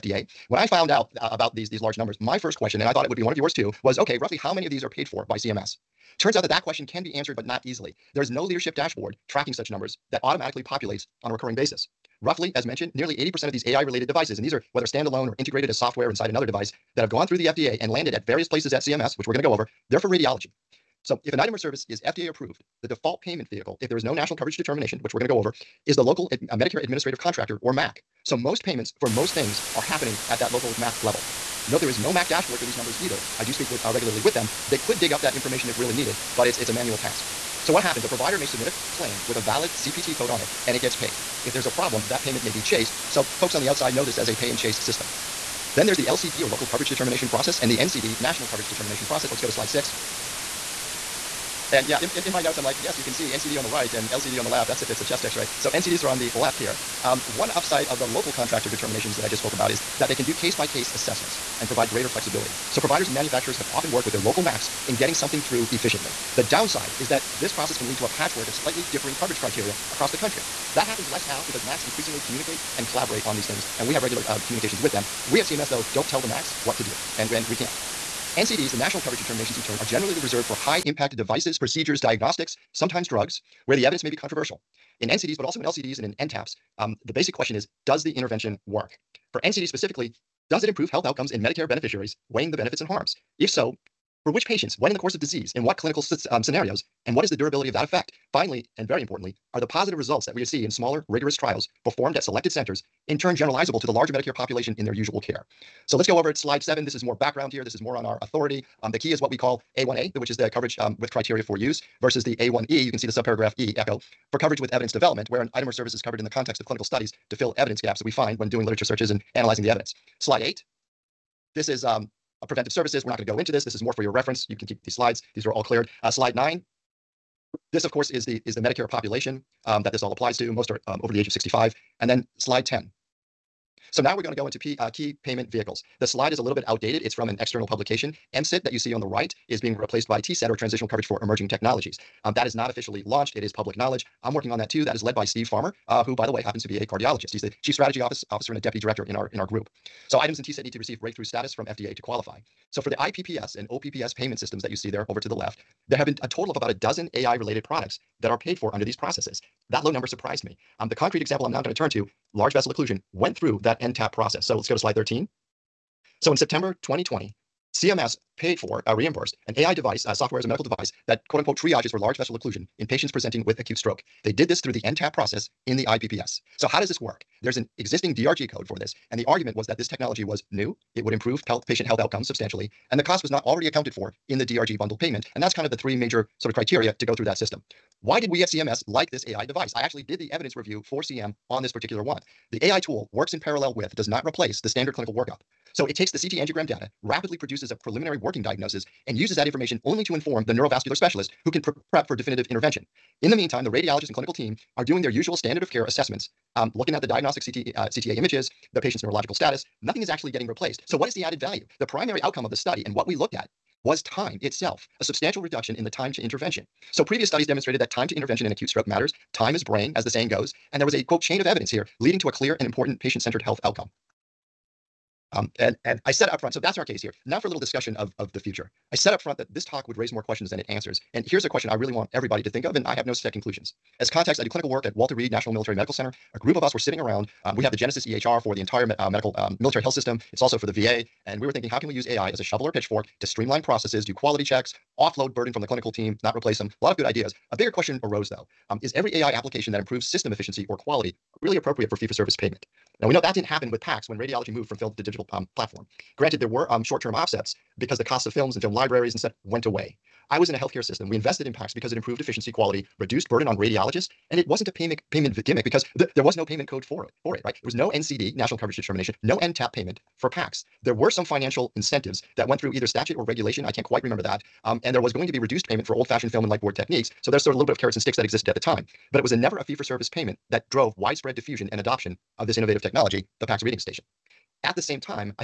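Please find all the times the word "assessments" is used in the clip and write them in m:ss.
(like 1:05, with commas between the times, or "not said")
1:00, 3:25.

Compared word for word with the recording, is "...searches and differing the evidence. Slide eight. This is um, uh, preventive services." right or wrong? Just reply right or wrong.
wrong.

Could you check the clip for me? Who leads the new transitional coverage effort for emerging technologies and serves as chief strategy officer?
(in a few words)
Steve Farmer.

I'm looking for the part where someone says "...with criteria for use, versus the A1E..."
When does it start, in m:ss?
1:50.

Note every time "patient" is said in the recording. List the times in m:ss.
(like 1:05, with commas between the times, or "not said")
1:34, 2:52, 3:01, 3:28, 3:42.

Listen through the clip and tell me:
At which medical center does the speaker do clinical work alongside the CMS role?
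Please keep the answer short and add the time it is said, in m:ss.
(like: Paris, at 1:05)
Walter Reed National Military Medical Center, at 3:54.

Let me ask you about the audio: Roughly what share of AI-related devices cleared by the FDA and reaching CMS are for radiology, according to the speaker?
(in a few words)
80%.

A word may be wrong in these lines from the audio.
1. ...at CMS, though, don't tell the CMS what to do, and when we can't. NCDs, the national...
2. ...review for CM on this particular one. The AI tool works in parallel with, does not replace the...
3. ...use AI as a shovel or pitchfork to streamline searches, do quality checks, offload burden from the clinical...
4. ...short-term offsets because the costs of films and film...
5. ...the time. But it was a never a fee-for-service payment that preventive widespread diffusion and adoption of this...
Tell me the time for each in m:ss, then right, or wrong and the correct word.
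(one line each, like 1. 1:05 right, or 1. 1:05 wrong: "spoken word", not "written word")
1. 1:15 wrong: "MACs", not "CMS"
2. 3:10 right
3. 4:01 wrong: "processes", not "searches"
4. 4:16 right
5. 4:38 wrong: "drove", not "preventive".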